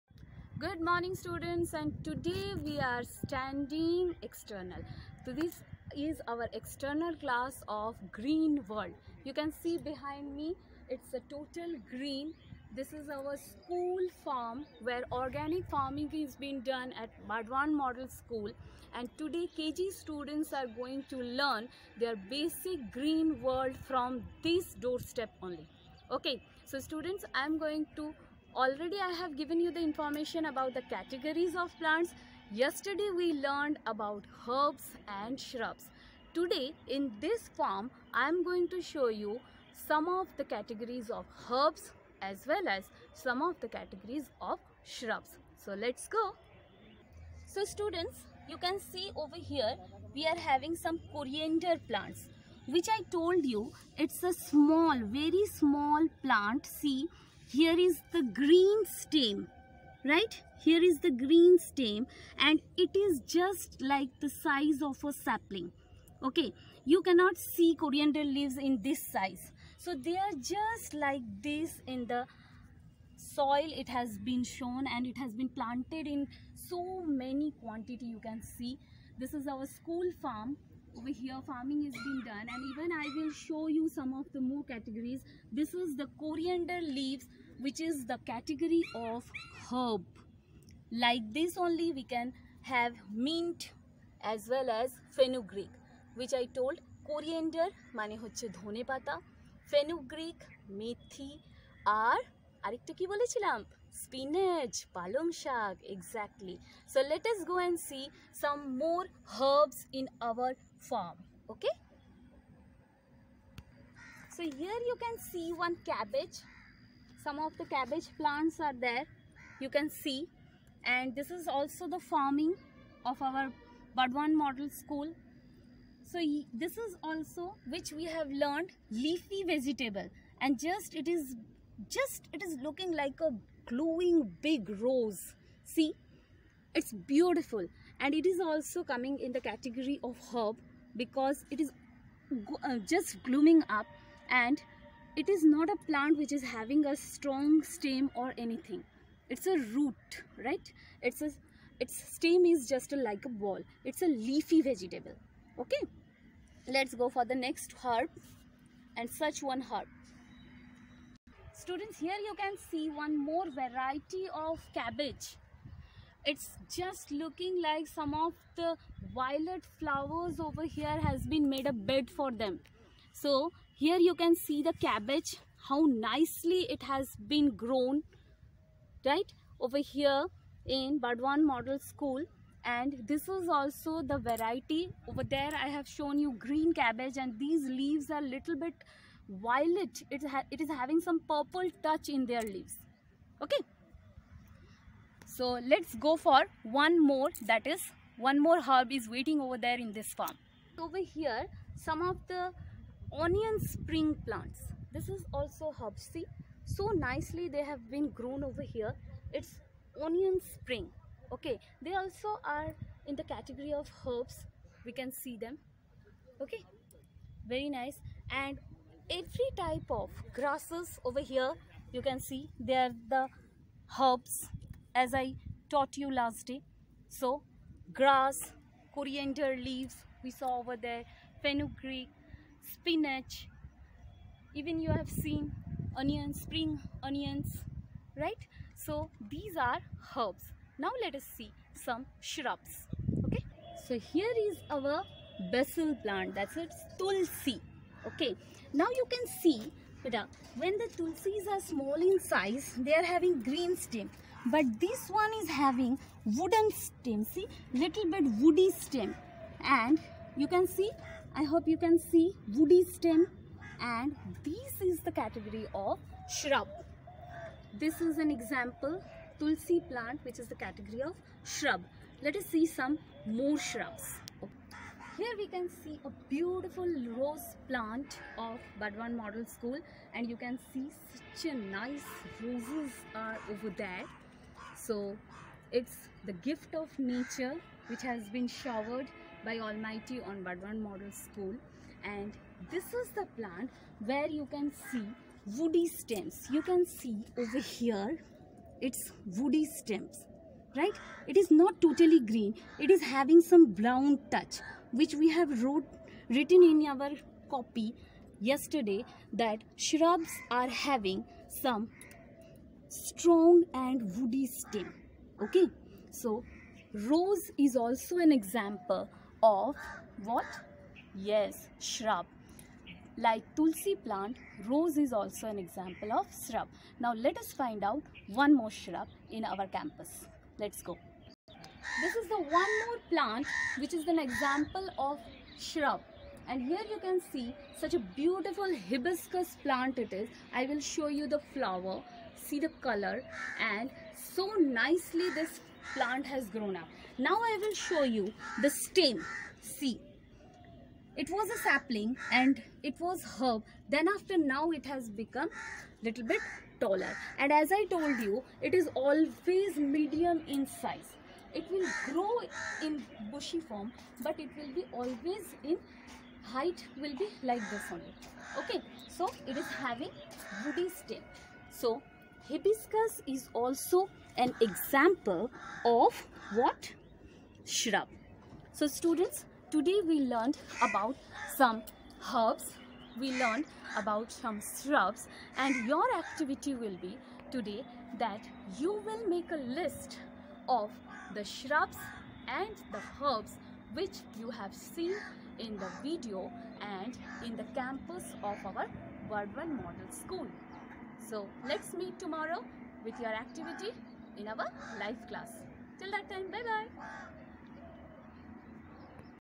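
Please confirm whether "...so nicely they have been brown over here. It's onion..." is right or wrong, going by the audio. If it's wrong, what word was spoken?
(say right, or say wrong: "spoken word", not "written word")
wrong: "grown", not "brown".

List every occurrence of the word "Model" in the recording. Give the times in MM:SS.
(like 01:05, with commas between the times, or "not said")
00:17, 02:04, 03:01, 04:39, 04:50, 06:39.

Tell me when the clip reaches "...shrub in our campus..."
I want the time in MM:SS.
05:28.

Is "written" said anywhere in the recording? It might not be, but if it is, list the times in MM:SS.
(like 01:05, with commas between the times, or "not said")
05:06.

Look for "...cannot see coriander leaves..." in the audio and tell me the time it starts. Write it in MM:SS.
01:07.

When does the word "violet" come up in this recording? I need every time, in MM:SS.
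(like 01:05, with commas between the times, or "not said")
02:49, 03:09.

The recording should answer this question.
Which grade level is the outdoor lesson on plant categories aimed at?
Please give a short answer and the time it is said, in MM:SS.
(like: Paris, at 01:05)
KG, at 00:19.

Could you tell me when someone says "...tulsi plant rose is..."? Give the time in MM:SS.
05:23.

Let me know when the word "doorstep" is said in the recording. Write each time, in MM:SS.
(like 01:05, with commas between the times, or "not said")
00:24.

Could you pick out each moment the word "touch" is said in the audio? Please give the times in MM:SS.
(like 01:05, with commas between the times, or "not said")
03:11, 05:04.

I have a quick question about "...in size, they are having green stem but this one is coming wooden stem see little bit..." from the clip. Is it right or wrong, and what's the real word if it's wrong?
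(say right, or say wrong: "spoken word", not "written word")
wrong: "having", not "coming".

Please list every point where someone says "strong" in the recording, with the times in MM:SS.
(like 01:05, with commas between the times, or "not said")
02:26, 05:12.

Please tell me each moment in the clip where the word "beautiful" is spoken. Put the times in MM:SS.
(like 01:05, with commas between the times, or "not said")
02:17, 04:36, 05:38.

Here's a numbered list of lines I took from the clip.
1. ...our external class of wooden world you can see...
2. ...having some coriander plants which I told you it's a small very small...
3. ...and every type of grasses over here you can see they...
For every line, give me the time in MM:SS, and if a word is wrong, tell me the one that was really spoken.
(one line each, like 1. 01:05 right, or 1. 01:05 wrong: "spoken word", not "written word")
1. 00:06 wrong: "green", not "wooden"
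2. 00:50 right
3. 03:38 right.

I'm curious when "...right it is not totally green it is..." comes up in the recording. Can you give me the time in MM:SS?
05:00.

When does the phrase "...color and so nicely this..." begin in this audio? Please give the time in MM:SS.
05:42.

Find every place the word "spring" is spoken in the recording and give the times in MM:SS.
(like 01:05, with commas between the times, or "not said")
03:23, 03:30, 03:56.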